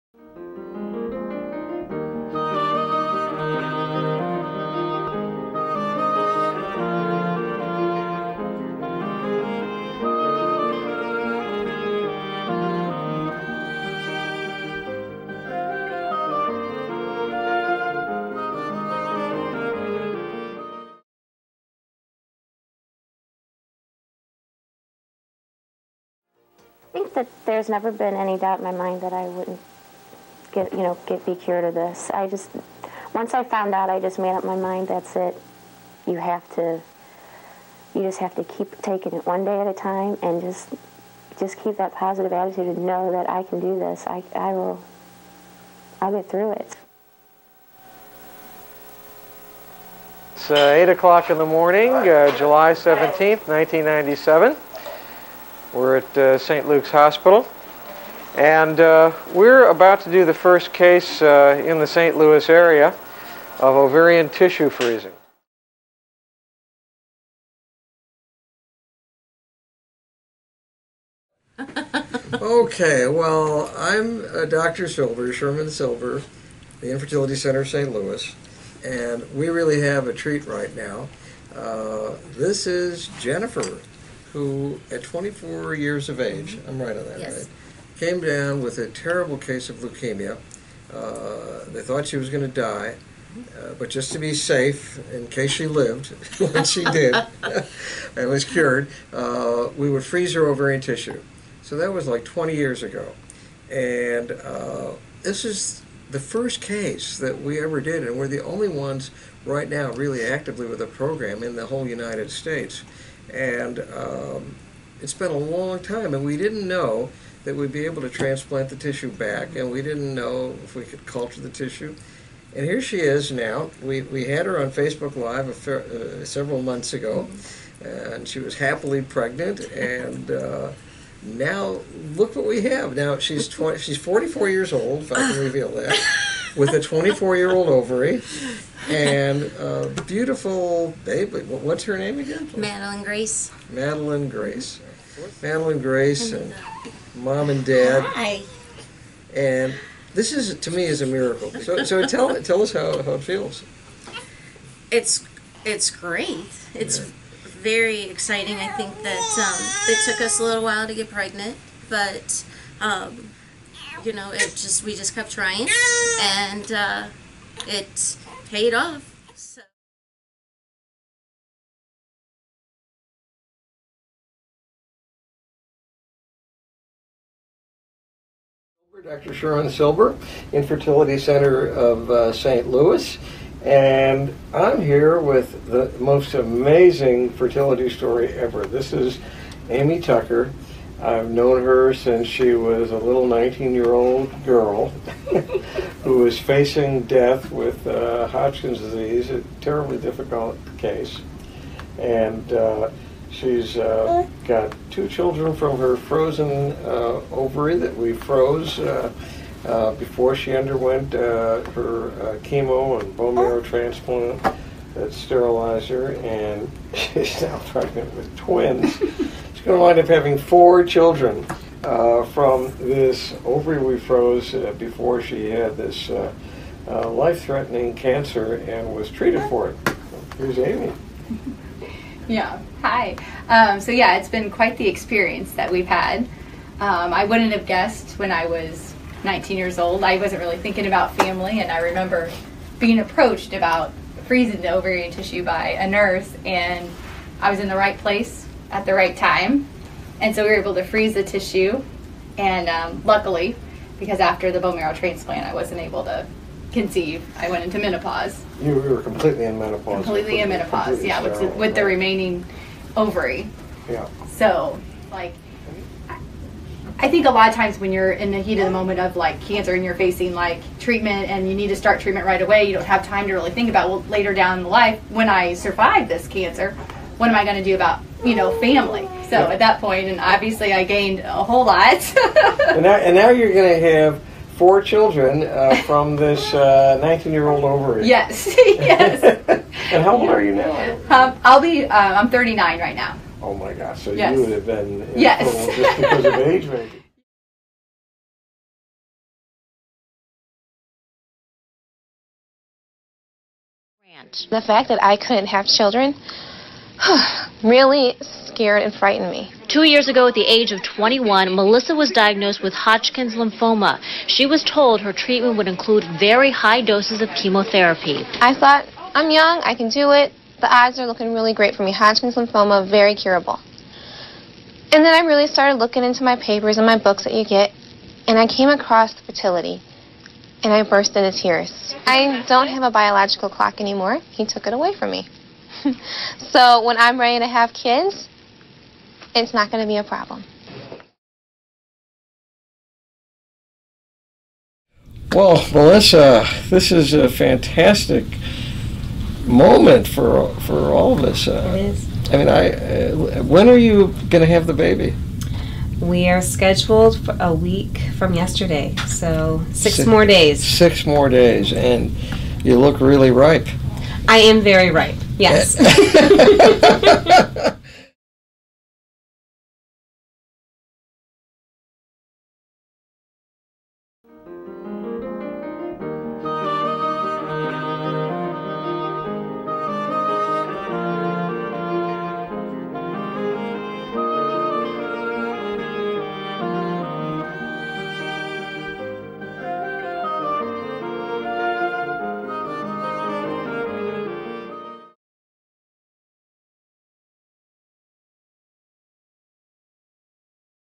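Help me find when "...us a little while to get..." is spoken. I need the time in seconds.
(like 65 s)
160 s.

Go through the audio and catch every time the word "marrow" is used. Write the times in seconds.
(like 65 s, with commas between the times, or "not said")
213 s, 254 s.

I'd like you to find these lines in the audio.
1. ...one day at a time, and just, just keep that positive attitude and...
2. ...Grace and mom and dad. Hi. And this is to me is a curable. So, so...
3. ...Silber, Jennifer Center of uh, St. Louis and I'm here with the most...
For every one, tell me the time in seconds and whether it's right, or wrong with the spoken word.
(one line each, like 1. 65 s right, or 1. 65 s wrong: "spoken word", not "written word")
1. 39 s right
2. 145 s wrong: "miracle", not "curable"
3. 179 s wrong: "Infertility", not "Jennifer".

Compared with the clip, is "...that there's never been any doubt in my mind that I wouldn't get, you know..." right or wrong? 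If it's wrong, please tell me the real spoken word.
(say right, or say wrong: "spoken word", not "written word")
right.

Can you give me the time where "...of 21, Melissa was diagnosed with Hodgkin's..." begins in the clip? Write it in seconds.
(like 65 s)
310 s.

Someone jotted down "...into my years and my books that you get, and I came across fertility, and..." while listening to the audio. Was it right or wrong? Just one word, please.
wrong.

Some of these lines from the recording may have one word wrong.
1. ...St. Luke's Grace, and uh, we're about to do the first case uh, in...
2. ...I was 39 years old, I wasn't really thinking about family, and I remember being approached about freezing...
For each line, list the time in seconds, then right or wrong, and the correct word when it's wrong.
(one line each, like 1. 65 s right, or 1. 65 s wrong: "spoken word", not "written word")
1. 56 s wrong: "Hospital", not "Grace"
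2. 238 s wrong: "19", not "39".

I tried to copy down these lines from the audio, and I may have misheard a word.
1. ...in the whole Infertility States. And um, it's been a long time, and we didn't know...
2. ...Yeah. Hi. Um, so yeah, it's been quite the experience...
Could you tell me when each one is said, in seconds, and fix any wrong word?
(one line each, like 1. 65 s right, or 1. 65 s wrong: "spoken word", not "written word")
1. 111 s wrong: "United", not "Infertility"
2. 232 s right.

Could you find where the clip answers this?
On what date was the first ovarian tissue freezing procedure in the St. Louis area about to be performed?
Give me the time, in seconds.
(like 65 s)
52 s.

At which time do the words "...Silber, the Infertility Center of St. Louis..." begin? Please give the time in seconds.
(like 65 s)
75 s.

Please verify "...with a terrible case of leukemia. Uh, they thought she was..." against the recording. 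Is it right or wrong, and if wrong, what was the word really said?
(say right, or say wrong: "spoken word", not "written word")
right.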